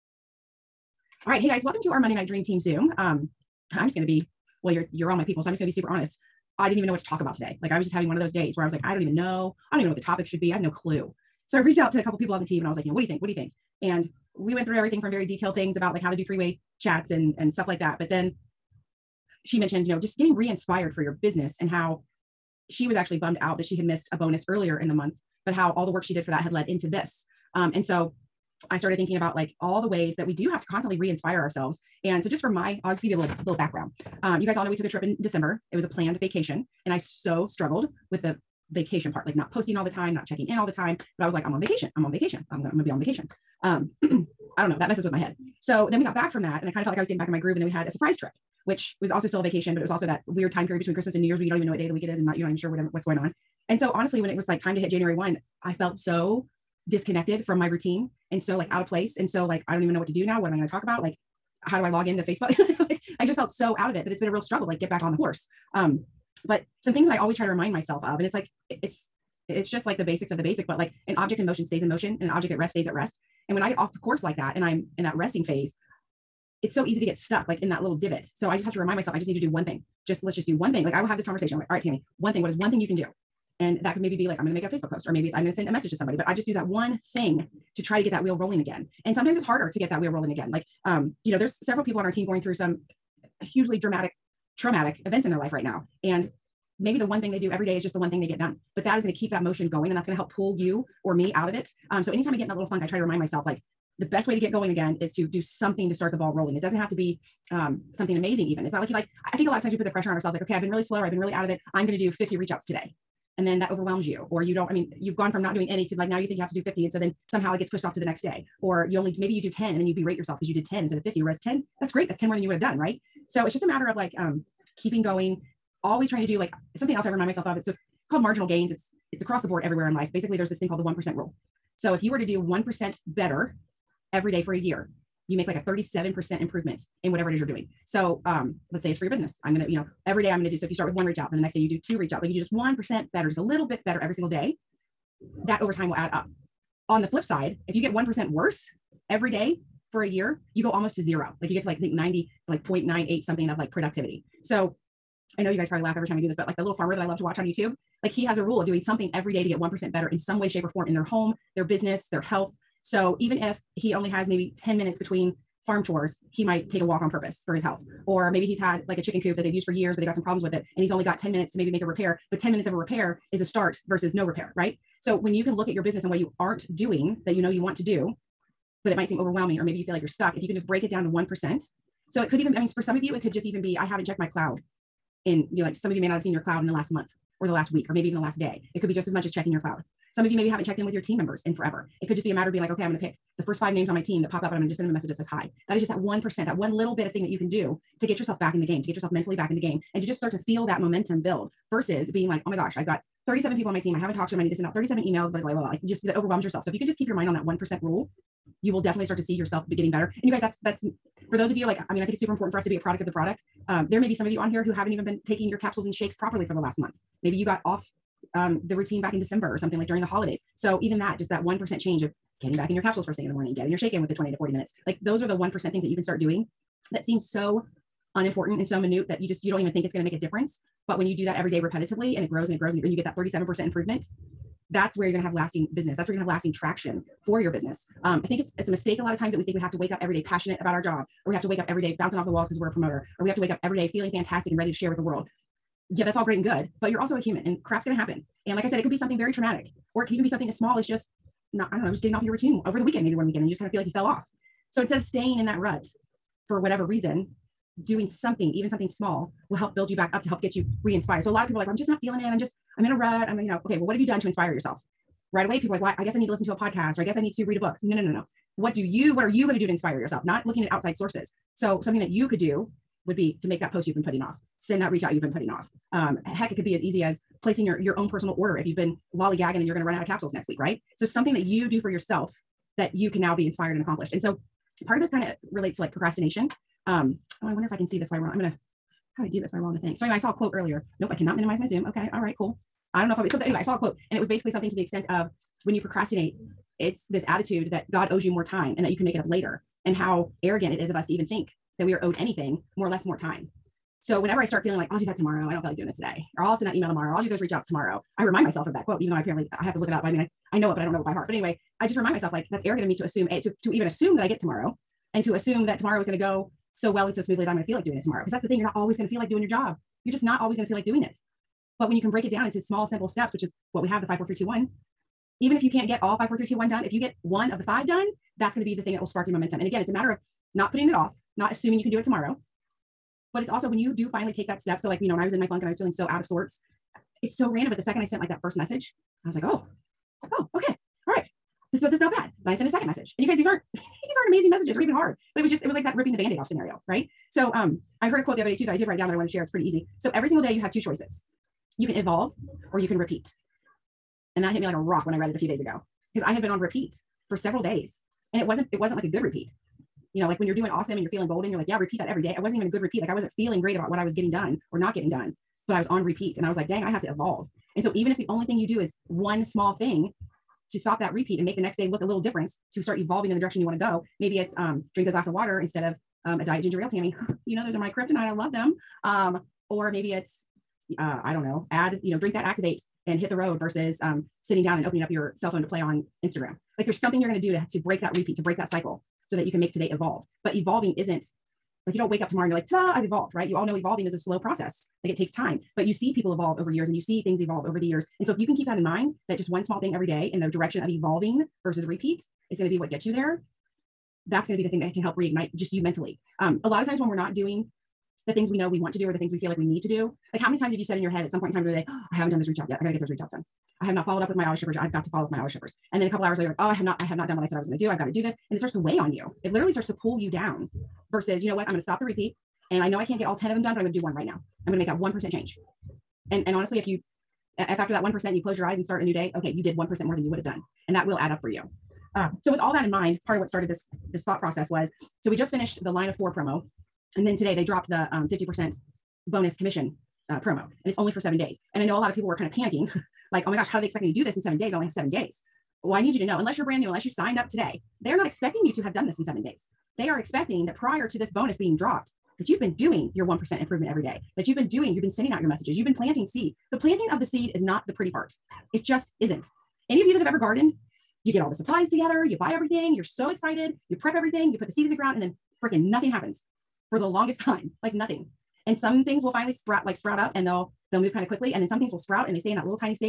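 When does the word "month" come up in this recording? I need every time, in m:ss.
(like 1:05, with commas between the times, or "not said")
0:24, 3:06, 3:36.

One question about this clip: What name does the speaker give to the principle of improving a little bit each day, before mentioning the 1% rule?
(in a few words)
Marginal gains.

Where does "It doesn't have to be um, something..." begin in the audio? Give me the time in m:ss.
1:46.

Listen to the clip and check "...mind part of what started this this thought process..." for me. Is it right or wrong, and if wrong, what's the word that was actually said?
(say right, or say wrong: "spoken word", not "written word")
right.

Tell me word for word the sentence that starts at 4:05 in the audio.
Yeah, that's all great and good, but you're also a human, and crap's going to happen.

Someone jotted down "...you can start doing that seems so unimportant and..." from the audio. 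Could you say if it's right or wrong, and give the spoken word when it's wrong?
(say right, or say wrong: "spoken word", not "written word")
right.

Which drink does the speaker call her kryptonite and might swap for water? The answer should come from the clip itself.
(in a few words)
Diet ginger ale.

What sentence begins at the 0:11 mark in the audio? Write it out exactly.
So I reached out to a couple people on the team and I was like, you know, what do you think?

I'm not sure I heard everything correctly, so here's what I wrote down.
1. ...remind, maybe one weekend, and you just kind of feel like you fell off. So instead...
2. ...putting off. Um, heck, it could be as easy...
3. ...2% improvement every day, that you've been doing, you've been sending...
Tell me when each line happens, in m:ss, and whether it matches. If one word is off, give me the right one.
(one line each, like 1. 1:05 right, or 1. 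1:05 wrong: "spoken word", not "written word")
1. 4:12 wrong: "weekend", not "remind"
2. 4:35 right
3. 7:33 wrong: "1", not "2".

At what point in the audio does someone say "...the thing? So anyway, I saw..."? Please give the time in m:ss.
4:49.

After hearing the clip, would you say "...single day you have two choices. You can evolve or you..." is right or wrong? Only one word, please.
right.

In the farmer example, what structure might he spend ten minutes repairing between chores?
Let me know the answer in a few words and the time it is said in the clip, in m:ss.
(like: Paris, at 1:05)
Chicken coop, at 2:48.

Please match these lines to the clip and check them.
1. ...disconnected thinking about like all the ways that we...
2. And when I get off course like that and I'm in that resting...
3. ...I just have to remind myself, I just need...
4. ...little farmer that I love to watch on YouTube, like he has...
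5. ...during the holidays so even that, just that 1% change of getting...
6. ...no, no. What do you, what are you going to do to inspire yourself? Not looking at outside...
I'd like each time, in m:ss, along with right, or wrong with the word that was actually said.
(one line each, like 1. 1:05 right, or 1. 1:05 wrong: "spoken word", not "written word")
1. 0:28 wrong: "started", not "disconnected"
2. 1:13 right
3. 1:18 right
4. 2:36 right
5. 3:39 right
6. 4:28 right.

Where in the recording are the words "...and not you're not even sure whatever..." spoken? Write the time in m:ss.
0:52.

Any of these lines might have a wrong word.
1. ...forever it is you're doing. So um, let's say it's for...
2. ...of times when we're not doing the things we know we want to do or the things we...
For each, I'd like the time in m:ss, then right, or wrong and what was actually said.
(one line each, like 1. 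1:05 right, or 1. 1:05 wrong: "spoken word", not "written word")
1. 2:17 wrong: "whatever", not "forever"
2. 6:46 right.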